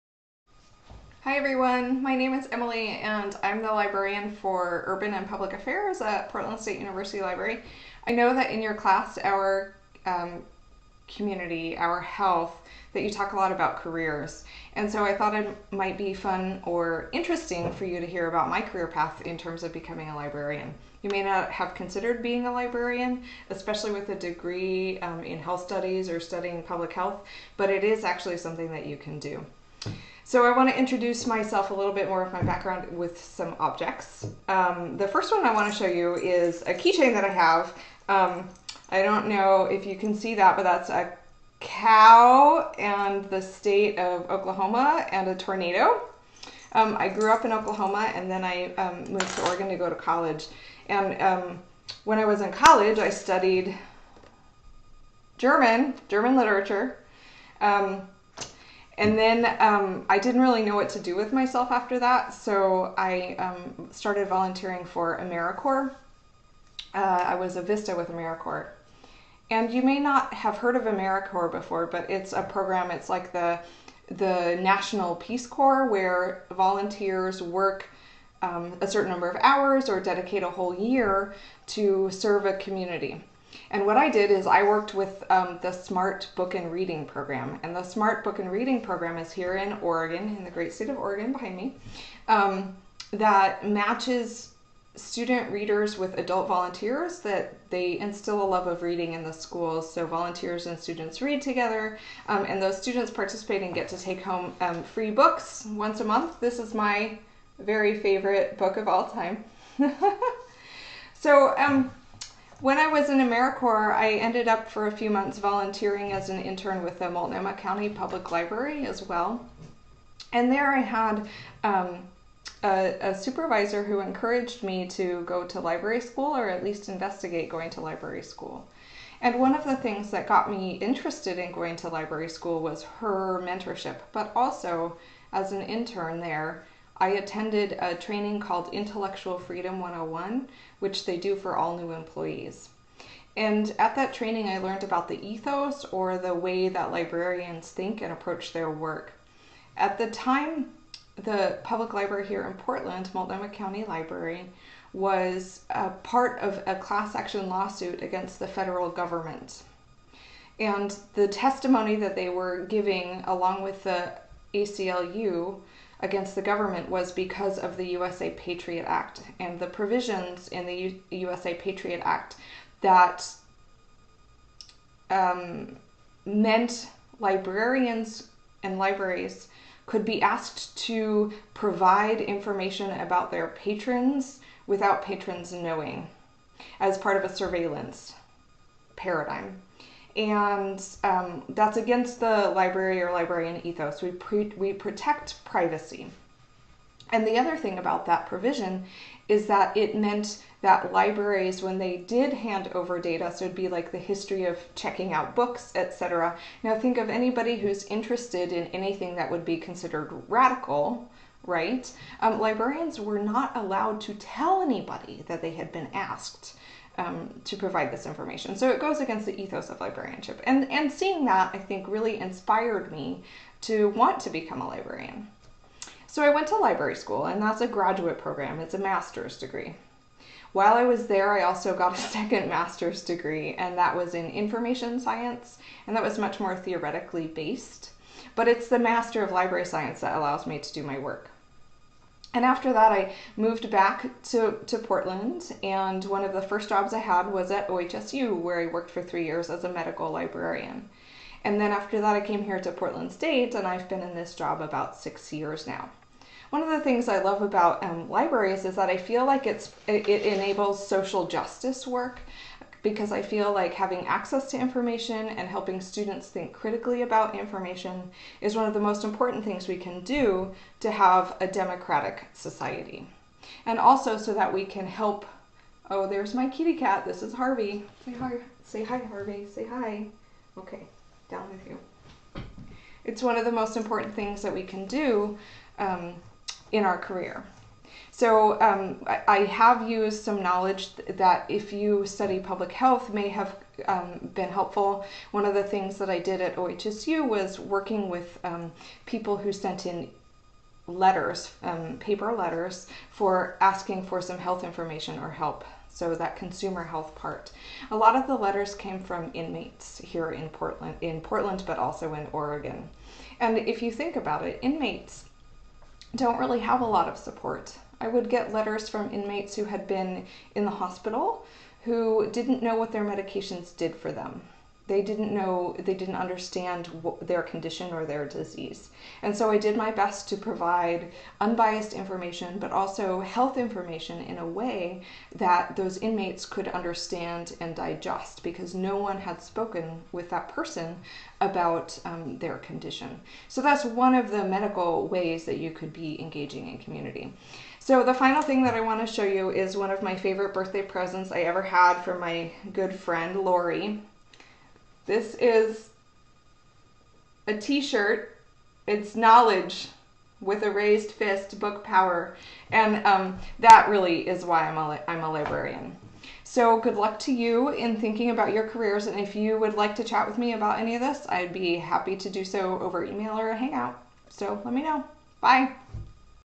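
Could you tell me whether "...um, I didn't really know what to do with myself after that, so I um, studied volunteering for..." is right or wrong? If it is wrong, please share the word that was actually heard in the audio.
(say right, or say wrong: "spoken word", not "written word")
wrong: "started", not "studied".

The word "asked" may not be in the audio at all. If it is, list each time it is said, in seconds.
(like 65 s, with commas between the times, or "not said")
180 s, 215 s.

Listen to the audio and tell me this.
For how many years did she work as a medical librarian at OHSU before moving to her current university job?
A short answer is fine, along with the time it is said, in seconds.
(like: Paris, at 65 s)
3, at 249 s.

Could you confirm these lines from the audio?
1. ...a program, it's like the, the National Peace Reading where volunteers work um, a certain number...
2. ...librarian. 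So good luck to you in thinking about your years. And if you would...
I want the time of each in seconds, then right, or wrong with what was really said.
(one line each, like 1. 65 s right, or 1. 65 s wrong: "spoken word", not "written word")
1. 72 s wrong: "Corps", not "Reading"
2. 365 s wrong: "careers", not "years".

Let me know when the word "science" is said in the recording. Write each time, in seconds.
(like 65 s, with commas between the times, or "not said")
234 s, 239 s.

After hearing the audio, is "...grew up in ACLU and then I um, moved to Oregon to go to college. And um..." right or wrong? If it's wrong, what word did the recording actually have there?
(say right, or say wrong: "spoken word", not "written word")
wrong: "Oklahoma", not "ACLU".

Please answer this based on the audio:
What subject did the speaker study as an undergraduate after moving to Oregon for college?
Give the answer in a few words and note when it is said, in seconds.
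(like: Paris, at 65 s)
German literature, at 56 s.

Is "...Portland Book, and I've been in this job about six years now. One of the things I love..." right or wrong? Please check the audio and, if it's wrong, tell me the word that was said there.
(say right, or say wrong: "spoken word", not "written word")
wrong: "State", not "Book".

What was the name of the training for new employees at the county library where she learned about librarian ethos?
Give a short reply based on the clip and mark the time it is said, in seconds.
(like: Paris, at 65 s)
Intellectual Freedom 101, at 138 s.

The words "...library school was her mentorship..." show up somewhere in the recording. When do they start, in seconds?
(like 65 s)
131 s.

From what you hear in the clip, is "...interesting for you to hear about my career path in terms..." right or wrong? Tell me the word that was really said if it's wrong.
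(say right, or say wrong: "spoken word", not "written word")
right.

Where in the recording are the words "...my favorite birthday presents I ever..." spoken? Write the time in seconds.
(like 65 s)
350 s.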